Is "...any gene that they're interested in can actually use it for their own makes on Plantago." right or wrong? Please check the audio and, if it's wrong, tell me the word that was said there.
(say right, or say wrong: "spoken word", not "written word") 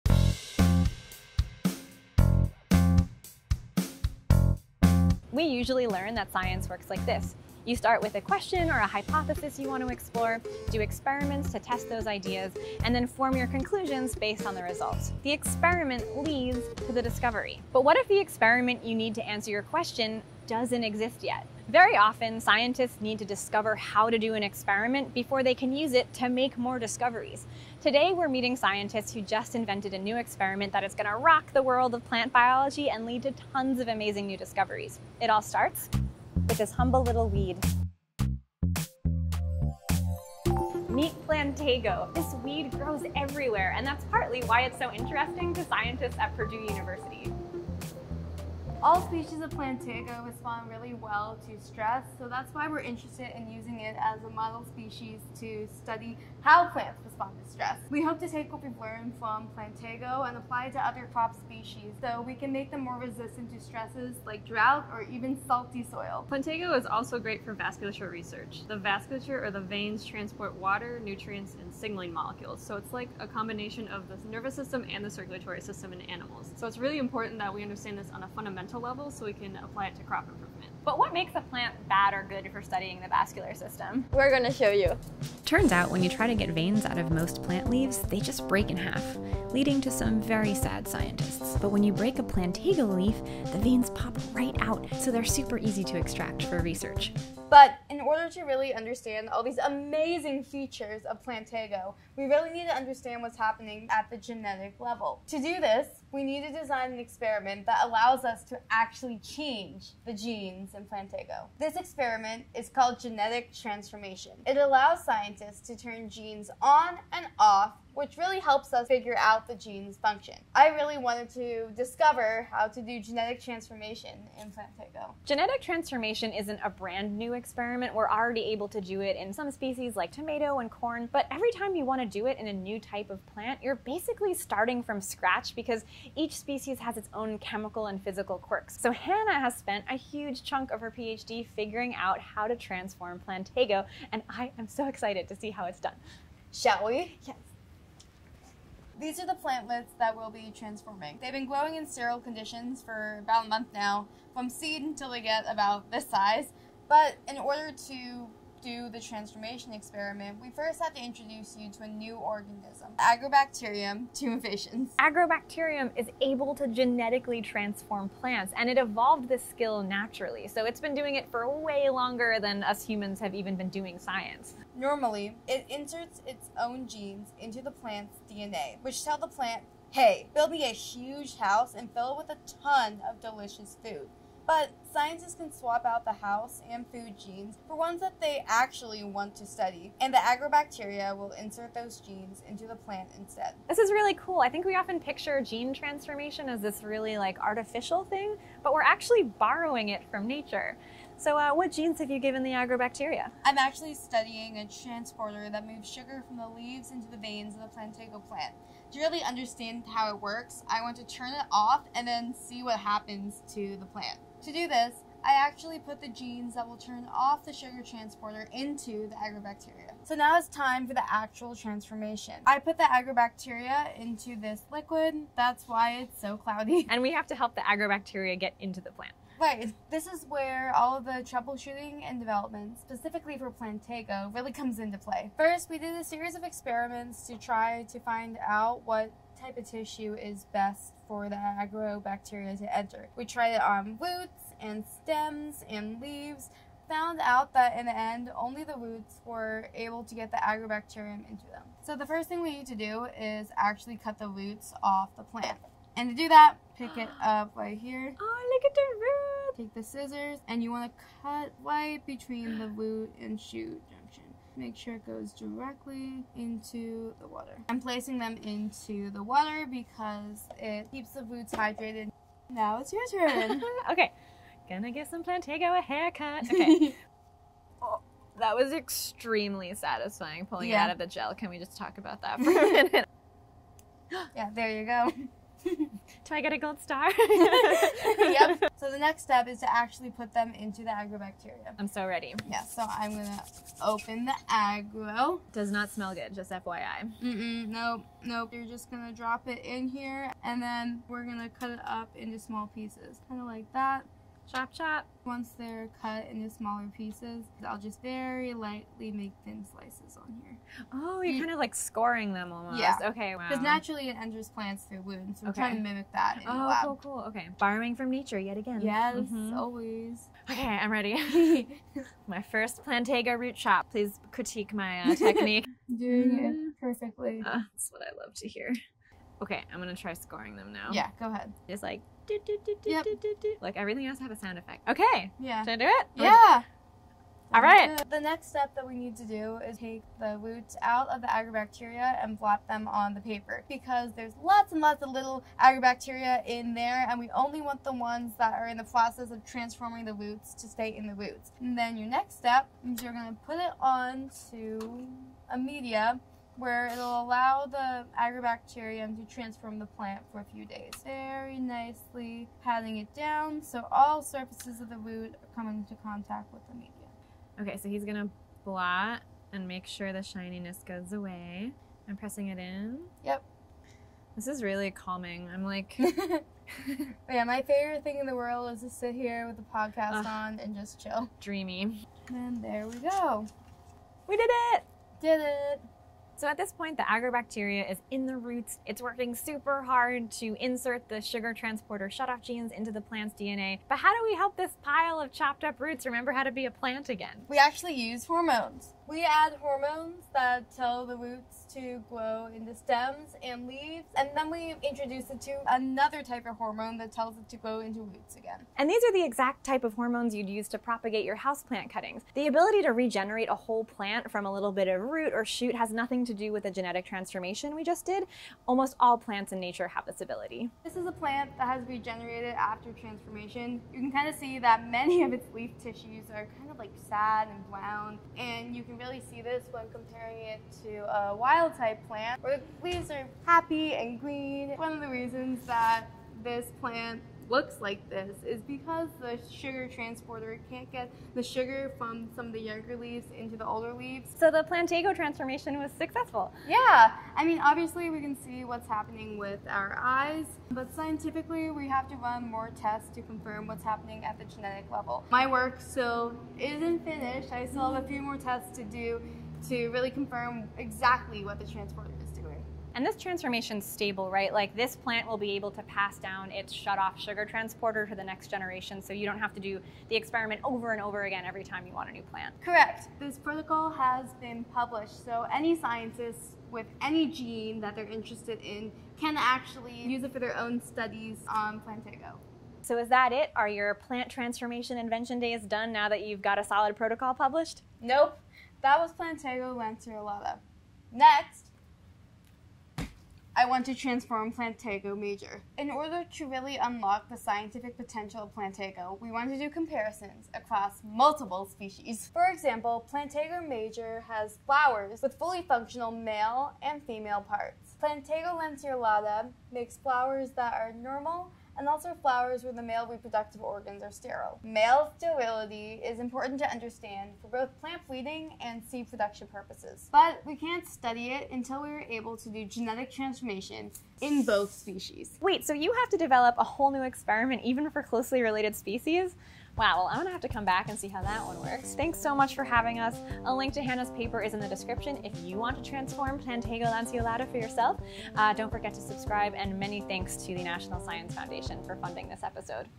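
wrong: "studies", not "makes".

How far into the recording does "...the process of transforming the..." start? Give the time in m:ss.
5:48.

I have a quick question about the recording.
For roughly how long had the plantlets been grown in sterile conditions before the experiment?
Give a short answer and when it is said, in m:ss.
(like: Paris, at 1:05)
About a month, at 2:33.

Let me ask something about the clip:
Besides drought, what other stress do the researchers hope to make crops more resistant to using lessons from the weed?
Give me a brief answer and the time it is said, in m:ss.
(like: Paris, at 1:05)
Salty soil, at 1:05.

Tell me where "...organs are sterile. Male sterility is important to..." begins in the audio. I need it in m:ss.
8:33.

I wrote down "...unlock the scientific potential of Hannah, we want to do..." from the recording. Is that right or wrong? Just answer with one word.
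wrong.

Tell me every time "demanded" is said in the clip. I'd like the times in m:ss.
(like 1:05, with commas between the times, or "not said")
not said.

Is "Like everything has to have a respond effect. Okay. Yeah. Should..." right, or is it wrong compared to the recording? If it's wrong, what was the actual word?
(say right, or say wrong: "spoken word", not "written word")
wrong: "sound", not "respond".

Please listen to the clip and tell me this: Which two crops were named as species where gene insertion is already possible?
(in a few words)
Tomato and corn.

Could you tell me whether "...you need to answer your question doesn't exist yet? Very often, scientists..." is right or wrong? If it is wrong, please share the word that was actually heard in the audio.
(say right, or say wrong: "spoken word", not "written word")
right.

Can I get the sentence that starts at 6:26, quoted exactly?
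So at this point, the agrobacteria is in the roots.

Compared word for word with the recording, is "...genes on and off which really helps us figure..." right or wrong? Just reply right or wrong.
right.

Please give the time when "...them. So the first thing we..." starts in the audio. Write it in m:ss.
4:11.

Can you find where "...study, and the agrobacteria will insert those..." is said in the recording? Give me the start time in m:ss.
3:09.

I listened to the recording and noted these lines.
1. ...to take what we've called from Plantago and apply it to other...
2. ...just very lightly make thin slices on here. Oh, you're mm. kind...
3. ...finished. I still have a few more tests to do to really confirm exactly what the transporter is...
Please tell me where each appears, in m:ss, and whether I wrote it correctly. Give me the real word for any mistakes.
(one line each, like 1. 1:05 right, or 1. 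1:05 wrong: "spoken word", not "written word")
1. 0:58 wrong: "learned", not "called"
2. 5:07 right
3. 7:37 right.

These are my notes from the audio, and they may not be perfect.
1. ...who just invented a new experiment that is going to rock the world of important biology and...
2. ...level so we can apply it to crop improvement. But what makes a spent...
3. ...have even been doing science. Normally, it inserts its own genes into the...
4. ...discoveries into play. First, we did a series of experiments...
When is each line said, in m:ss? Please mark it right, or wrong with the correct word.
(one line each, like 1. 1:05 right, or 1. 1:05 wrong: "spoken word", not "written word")
1. 0:29 wrong: "plant", not "important"
2. 1:19 wrong: "plant", not "spent"
3. 2:53 right
4. 3:54 wrong: "comes", not "discoveries".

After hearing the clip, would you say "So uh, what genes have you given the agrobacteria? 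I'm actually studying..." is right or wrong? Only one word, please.
right.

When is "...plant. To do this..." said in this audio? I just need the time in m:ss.
3:33.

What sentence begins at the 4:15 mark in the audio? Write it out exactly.
And to do that, pick it up right here.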